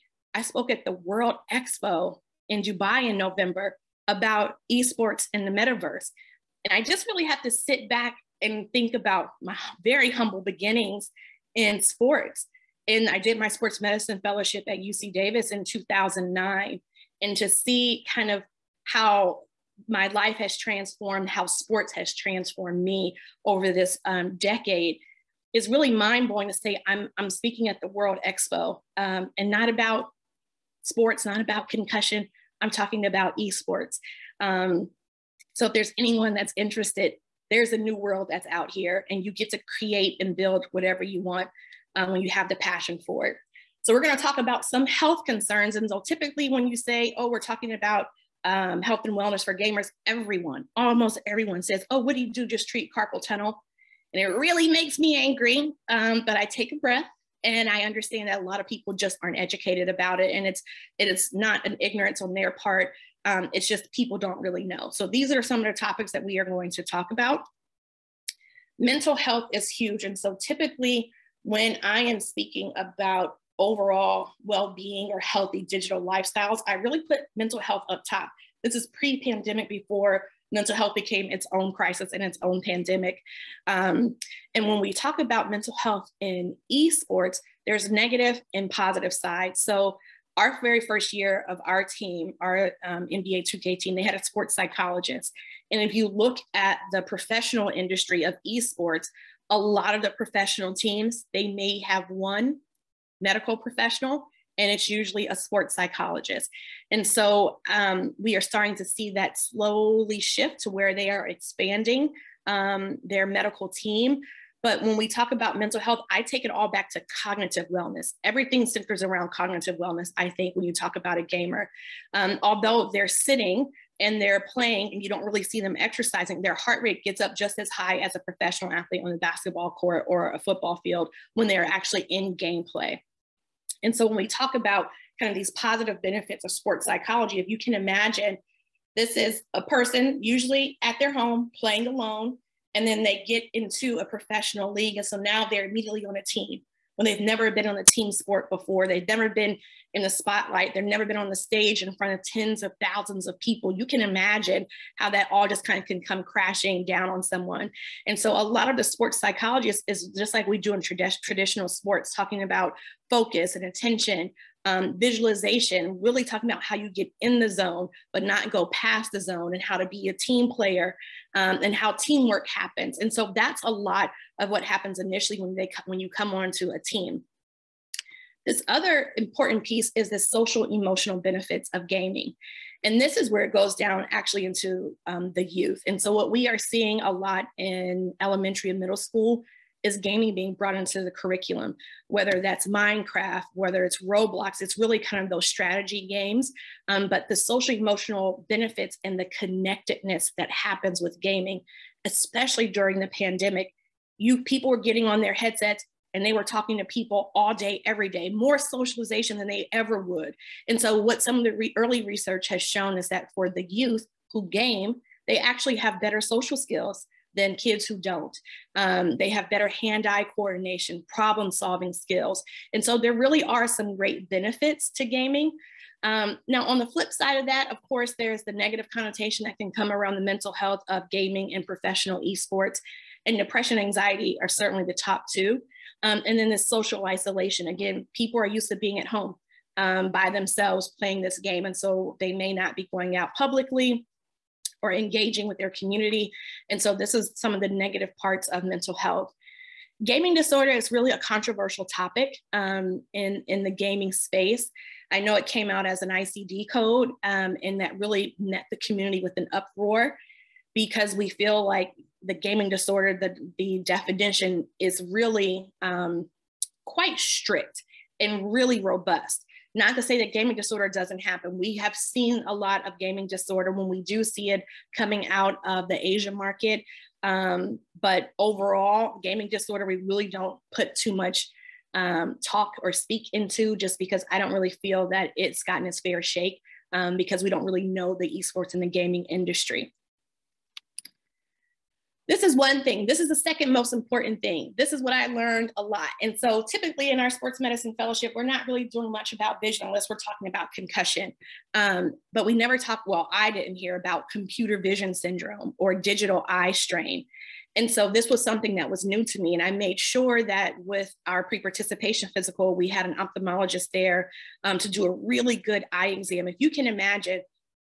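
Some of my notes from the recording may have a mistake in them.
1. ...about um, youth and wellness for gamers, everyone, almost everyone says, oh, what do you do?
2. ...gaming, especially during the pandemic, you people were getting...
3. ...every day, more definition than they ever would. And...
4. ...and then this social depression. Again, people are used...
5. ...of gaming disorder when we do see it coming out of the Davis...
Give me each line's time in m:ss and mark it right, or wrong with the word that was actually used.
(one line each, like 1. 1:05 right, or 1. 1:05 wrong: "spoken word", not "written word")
1. 0:47 wrong: "health", not "youth"
2. 3:21 right
3. 3:27 wrong: "socialization", not "definition"
4. 3:56 wrong: "isolation", not "depression"
5. 4:32 wrong: "Asian", not "Davis".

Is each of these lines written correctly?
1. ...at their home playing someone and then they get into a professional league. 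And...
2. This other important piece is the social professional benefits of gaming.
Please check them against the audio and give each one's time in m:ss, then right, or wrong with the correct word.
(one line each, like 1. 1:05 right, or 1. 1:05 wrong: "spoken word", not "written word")
1. 2:20 wrong: "alone", not "someone"
2. 2:58 wrong: "emotional", not "professional".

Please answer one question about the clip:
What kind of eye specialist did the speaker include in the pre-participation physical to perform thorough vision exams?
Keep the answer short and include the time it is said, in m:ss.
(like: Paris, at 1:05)
Ophthalmologist, at 5:13.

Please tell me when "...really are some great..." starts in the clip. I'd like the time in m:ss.
3:43.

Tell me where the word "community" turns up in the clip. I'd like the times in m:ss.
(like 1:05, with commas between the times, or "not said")
4:05, 4:18.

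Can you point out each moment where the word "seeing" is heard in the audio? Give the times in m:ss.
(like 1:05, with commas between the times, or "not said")
3:06.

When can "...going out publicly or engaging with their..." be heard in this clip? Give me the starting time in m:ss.
4:02.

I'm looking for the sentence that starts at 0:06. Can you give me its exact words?
And I just really have to sit back and think about my very humble beginnings in sports.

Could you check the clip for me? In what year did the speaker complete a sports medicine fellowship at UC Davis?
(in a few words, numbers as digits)
2009.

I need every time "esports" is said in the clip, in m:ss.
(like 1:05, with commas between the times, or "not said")
0:04, 0:33, 1:26, 1:38, 3:52, 4:48.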